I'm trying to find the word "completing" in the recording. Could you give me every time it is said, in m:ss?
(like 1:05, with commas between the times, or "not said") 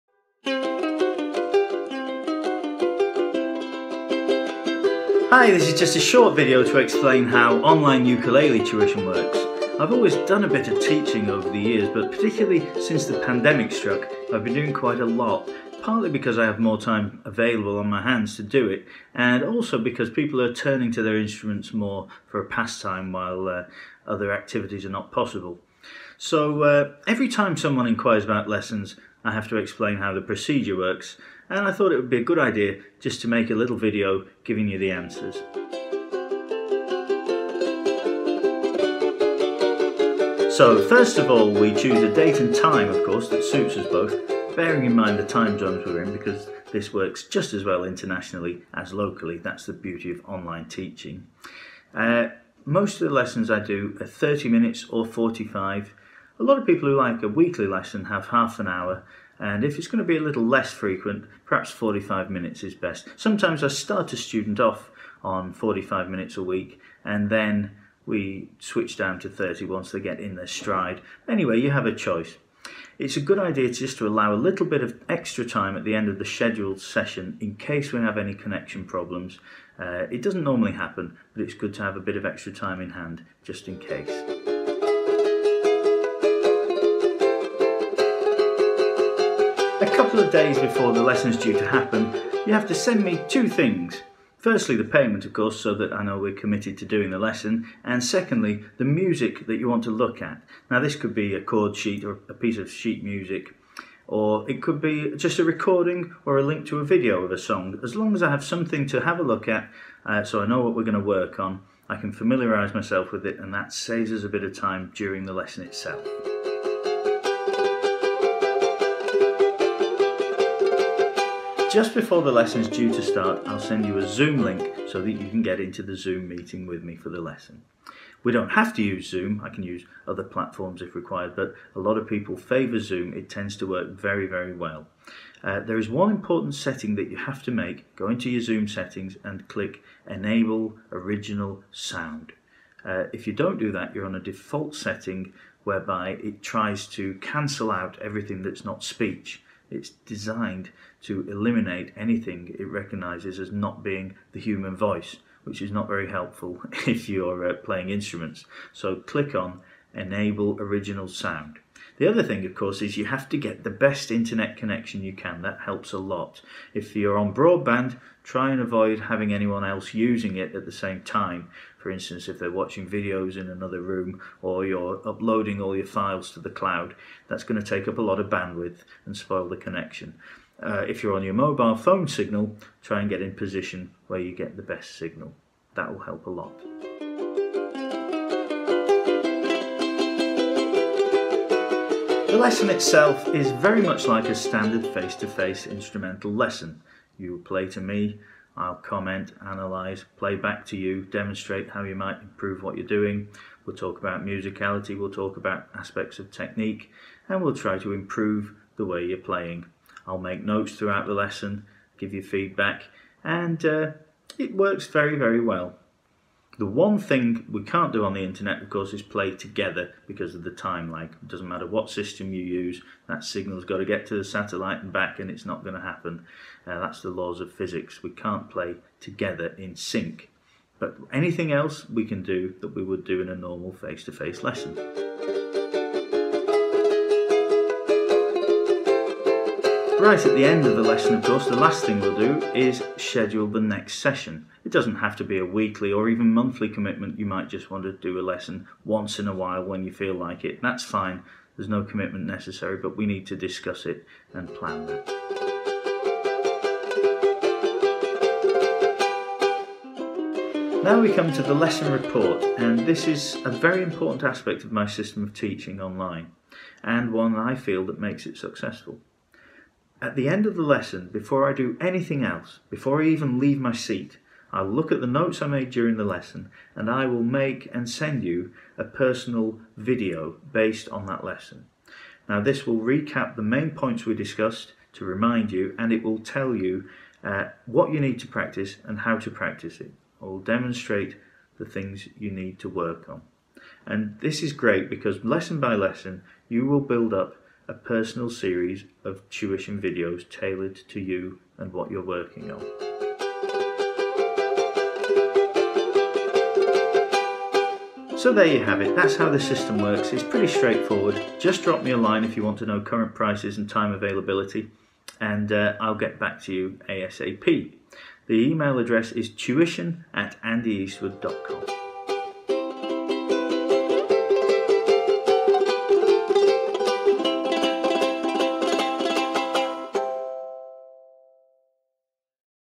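not said.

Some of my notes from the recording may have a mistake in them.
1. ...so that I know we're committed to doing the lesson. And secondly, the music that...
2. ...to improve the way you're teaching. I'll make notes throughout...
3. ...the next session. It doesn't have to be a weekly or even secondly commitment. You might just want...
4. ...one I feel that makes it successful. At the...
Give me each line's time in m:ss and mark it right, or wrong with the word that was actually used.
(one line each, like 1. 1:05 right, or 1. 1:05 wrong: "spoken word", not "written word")
1. 1:35 right
2. 3:27 wrong: "playing", not "teaching"
3. 4:03 wrong: "monthly", not "secondly"
4. 4:27 right.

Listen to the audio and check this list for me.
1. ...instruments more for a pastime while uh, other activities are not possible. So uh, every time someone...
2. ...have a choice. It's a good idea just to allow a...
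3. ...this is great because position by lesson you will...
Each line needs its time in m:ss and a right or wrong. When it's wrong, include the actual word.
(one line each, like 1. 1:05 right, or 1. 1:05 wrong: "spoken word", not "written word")
1. 0:21 right
2. 1:11 right
3. 4:54 wrong: "lesson", not "position".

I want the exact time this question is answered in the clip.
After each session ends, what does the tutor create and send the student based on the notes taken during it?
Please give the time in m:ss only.
4:38.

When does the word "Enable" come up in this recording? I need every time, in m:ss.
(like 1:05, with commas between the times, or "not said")
2:20, 2:39.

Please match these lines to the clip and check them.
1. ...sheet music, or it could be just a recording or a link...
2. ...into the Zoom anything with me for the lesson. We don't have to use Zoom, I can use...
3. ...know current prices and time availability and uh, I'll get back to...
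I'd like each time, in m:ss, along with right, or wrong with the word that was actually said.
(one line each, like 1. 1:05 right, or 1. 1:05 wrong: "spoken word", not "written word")
1. 1:42 right
2. 2:05 wrong: "meeting", not "anything"
3. 5:12 right.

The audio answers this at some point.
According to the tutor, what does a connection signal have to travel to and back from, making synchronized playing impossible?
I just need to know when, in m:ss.
3:44.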